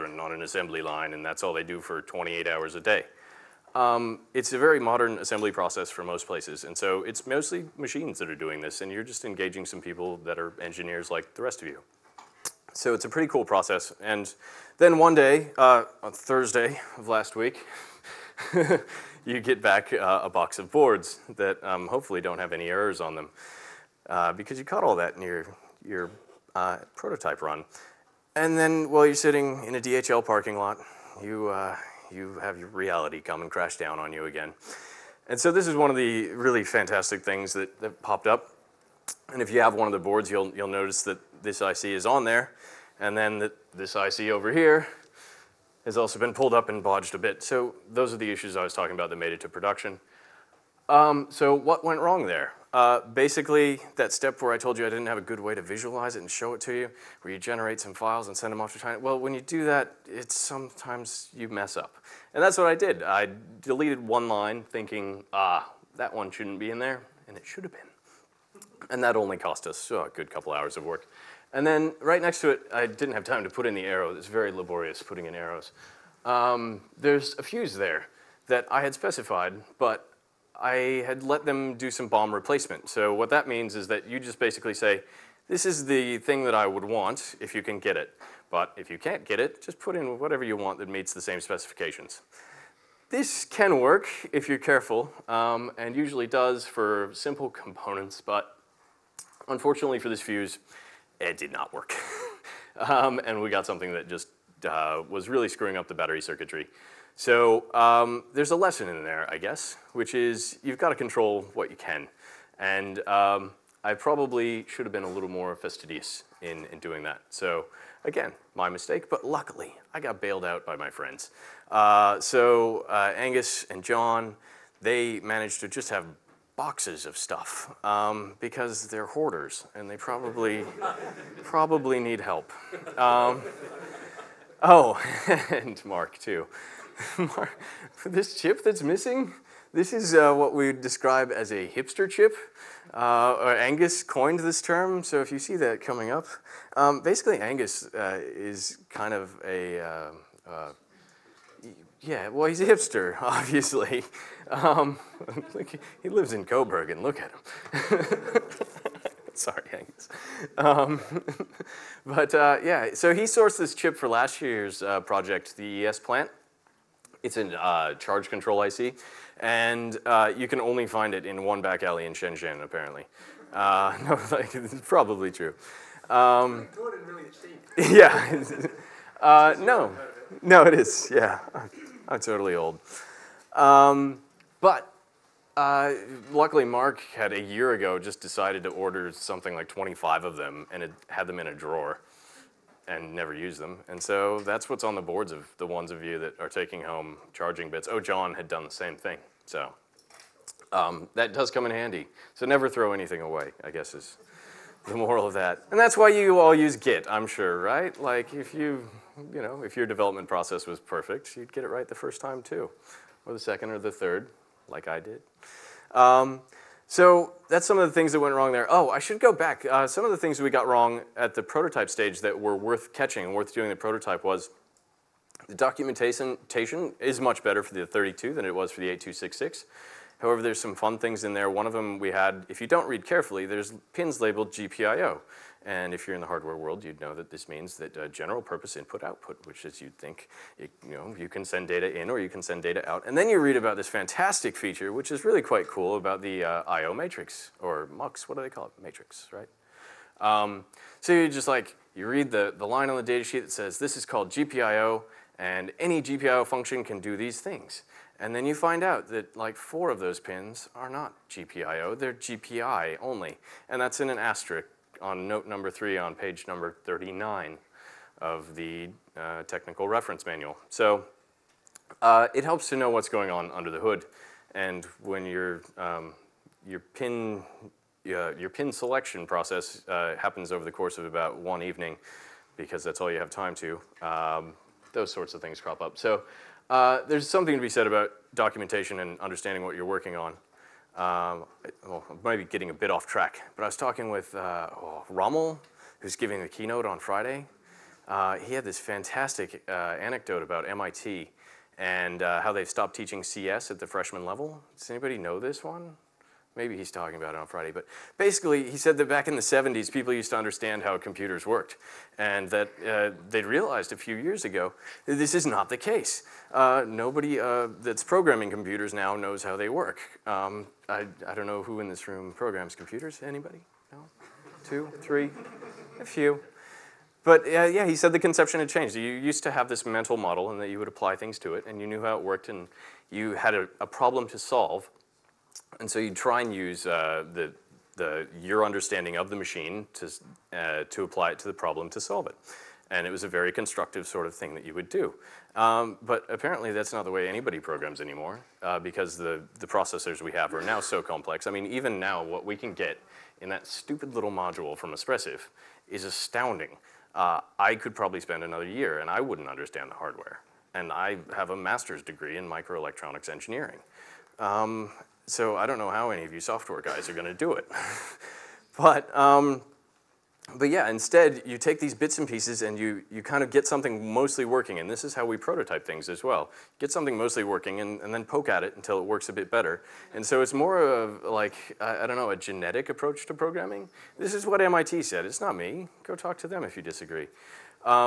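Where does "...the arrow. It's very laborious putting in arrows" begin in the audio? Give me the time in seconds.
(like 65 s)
73 s.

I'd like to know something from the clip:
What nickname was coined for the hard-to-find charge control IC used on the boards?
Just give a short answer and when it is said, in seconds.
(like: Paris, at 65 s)
hipster chip, at 141 s.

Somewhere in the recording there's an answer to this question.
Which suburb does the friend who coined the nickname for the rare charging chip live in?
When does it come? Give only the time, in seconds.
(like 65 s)
156 s.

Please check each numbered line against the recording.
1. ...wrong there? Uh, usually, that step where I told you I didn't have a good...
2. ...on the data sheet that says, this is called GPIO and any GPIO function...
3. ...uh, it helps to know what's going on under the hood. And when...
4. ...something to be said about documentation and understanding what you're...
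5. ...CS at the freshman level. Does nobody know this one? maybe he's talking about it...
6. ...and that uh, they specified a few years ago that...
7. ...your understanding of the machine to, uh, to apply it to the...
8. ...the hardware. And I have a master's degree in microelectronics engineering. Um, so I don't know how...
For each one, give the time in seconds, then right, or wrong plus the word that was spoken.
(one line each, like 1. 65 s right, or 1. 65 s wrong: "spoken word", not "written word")
1. 52 s wrong: "basically", not "usually"
2. 252 s right
3. 272 s right
4. 287 s right
5. 303 s wrong: "anybody", not "nobody"
6. 312 s wrong: "realized", not "specified"
7. 338 s right
8. 359 s right.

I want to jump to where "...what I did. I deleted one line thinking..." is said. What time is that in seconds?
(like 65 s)
62 s.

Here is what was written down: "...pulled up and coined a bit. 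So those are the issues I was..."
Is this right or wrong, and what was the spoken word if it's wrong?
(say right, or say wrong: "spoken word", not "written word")
wrong: "bodged", not "coined".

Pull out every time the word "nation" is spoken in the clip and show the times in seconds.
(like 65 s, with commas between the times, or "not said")
not said.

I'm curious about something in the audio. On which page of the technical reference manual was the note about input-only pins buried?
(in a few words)
39.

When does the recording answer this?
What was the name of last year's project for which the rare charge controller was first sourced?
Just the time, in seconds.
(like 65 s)
165 s.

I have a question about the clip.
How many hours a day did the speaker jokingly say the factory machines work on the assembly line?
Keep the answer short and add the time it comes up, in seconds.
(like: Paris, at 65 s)
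28, at 2 s.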